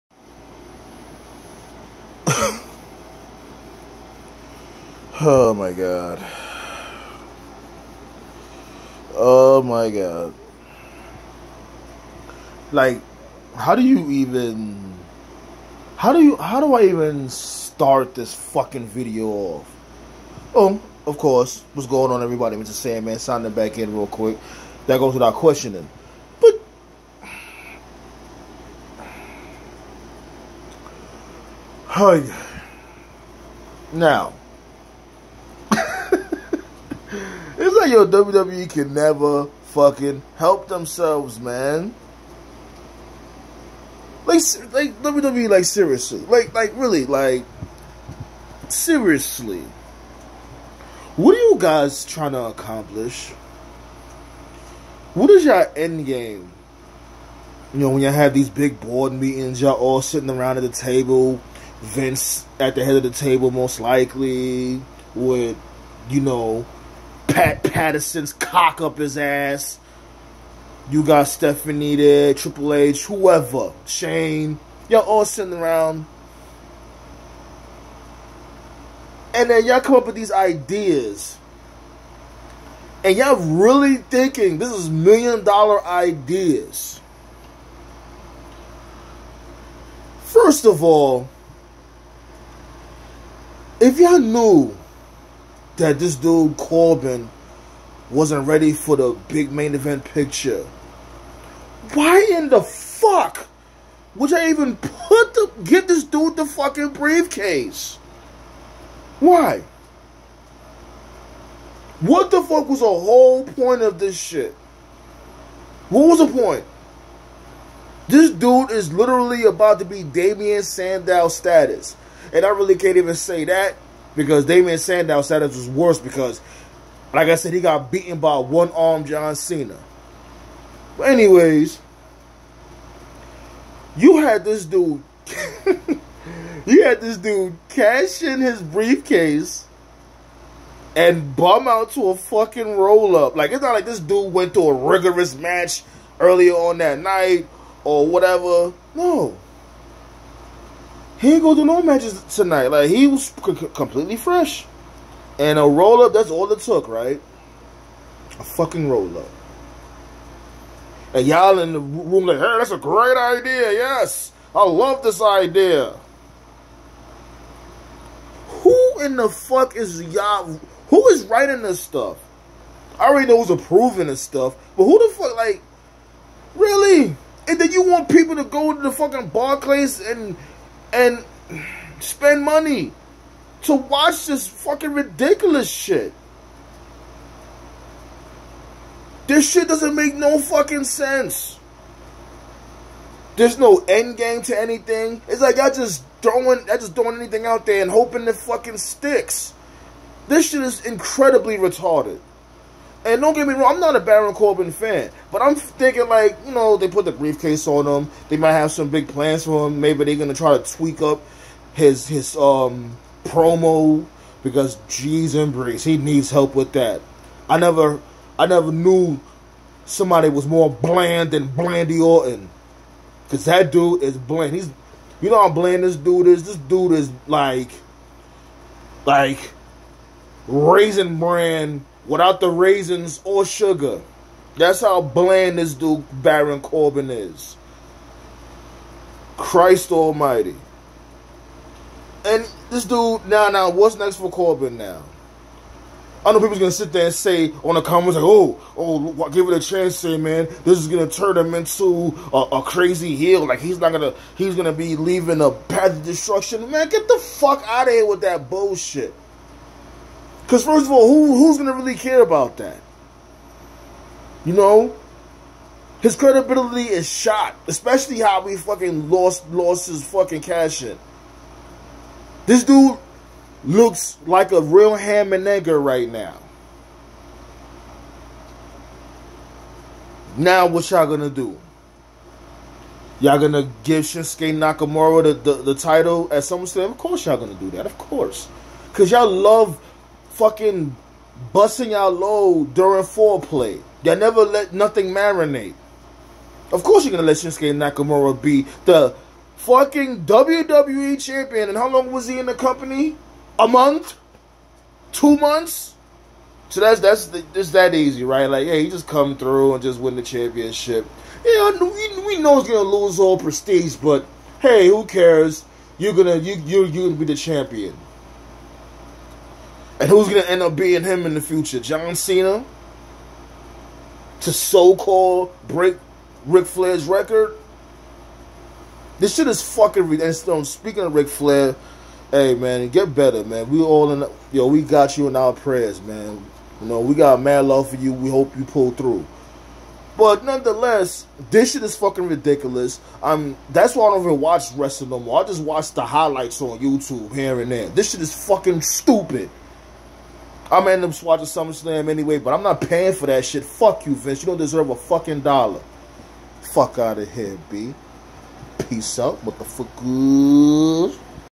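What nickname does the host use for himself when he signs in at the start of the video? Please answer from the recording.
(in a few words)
Mr. Sandman.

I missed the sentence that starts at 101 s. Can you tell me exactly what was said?
Why in the fuck would I even put the get this dude the fucking briefcase?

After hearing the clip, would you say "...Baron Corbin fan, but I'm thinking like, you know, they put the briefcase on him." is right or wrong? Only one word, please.
right.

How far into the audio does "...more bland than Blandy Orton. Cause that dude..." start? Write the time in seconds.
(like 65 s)
220 s.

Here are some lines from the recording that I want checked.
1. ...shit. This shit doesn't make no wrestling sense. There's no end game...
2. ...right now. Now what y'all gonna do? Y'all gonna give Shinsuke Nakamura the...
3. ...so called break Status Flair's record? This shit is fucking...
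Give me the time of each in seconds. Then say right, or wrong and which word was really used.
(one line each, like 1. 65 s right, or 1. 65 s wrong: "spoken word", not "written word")
1. 185 s wrong: "fucking", not "wrestling"
2. 275 s right
3. 324 s wrong: "Ric", not "Status".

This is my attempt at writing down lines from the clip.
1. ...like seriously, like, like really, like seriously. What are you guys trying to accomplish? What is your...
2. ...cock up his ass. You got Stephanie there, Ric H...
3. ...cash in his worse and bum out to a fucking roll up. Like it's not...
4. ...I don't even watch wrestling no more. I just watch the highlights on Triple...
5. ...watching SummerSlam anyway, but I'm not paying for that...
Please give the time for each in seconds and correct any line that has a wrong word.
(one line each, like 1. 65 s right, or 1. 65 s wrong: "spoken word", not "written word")
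1. 45 s right
2. 68 s wrong: "Triple", not "Ric"
3. 137 s wrong: "briefcase", not "worse"
4. 344 s wrong: "YouTube", not "Triple"
5. 351 s right.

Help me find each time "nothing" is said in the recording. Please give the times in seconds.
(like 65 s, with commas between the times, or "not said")
294 s.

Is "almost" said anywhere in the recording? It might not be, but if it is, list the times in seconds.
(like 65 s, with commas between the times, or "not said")
not said.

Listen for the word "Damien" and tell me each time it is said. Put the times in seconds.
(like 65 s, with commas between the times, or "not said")
120 s, 124 s.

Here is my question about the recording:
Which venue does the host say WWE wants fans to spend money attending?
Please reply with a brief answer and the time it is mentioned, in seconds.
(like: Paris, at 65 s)
Barclays, at 179 s.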